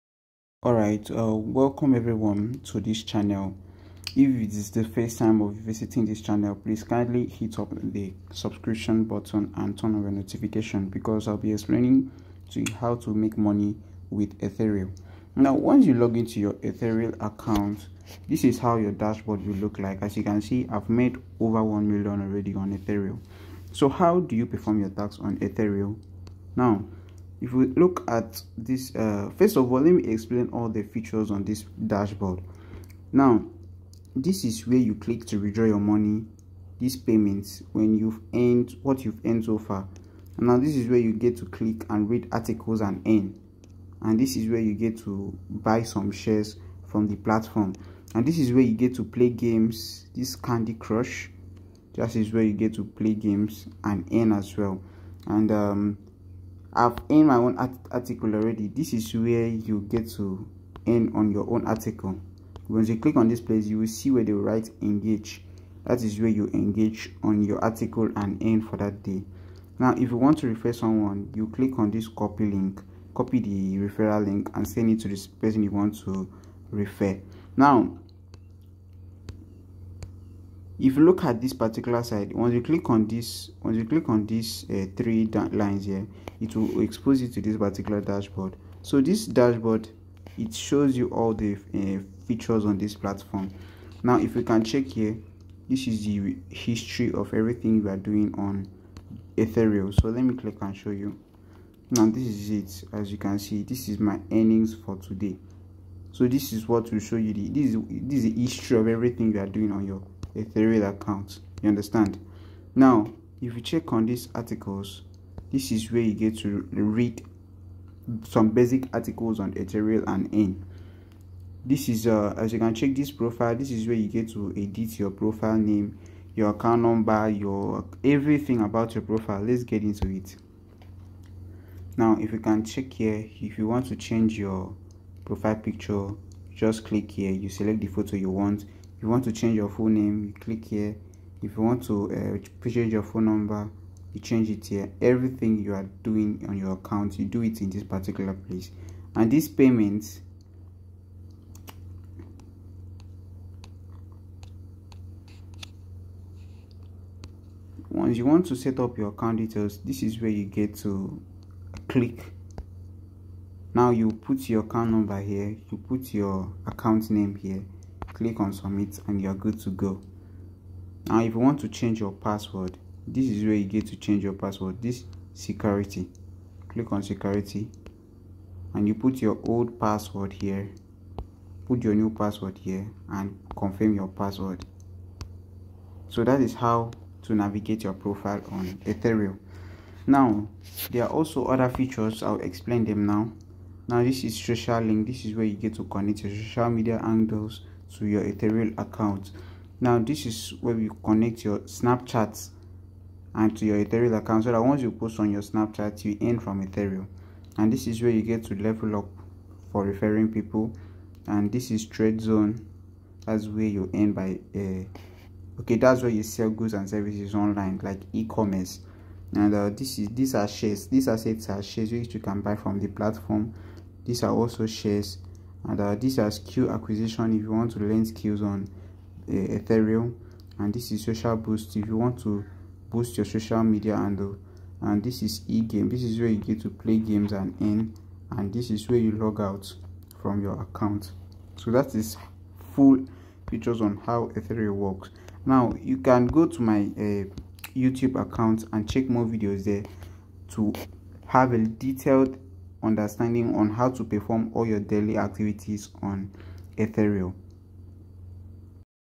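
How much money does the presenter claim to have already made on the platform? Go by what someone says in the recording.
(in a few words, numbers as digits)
Over 1 million.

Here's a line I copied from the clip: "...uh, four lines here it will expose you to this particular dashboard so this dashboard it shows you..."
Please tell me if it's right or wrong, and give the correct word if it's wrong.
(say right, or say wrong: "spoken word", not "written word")
wrong: "three", not "four".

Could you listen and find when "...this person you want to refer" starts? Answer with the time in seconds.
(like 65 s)
75 s.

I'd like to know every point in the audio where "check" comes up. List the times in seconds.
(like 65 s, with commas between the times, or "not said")
94 s, 113 s, 122 s, 132 s, 248 s.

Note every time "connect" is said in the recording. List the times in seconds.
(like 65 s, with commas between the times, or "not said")
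195 s, 201 s.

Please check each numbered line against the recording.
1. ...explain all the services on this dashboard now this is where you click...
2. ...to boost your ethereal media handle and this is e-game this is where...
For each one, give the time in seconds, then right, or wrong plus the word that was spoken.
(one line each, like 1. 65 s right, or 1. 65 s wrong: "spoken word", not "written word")
1. 30 s wrong: "features", not "services"
2. 232 s wrong: "social", not "ethereal".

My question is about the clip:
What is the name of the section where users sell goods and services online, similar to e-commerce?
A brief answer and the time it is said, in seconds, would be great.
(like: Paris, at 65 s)
Trade zone, at 211 s.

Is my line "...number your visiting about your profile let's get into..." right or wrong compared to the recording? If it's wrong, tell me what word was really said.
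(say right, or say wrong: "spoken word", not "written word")
wrong: "everything", not "visiting".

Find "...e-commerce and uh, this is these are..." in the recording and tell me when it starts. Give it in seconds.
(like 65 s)
218 s.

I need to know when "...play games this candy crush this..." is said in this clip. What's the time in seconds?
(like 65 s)
49 s.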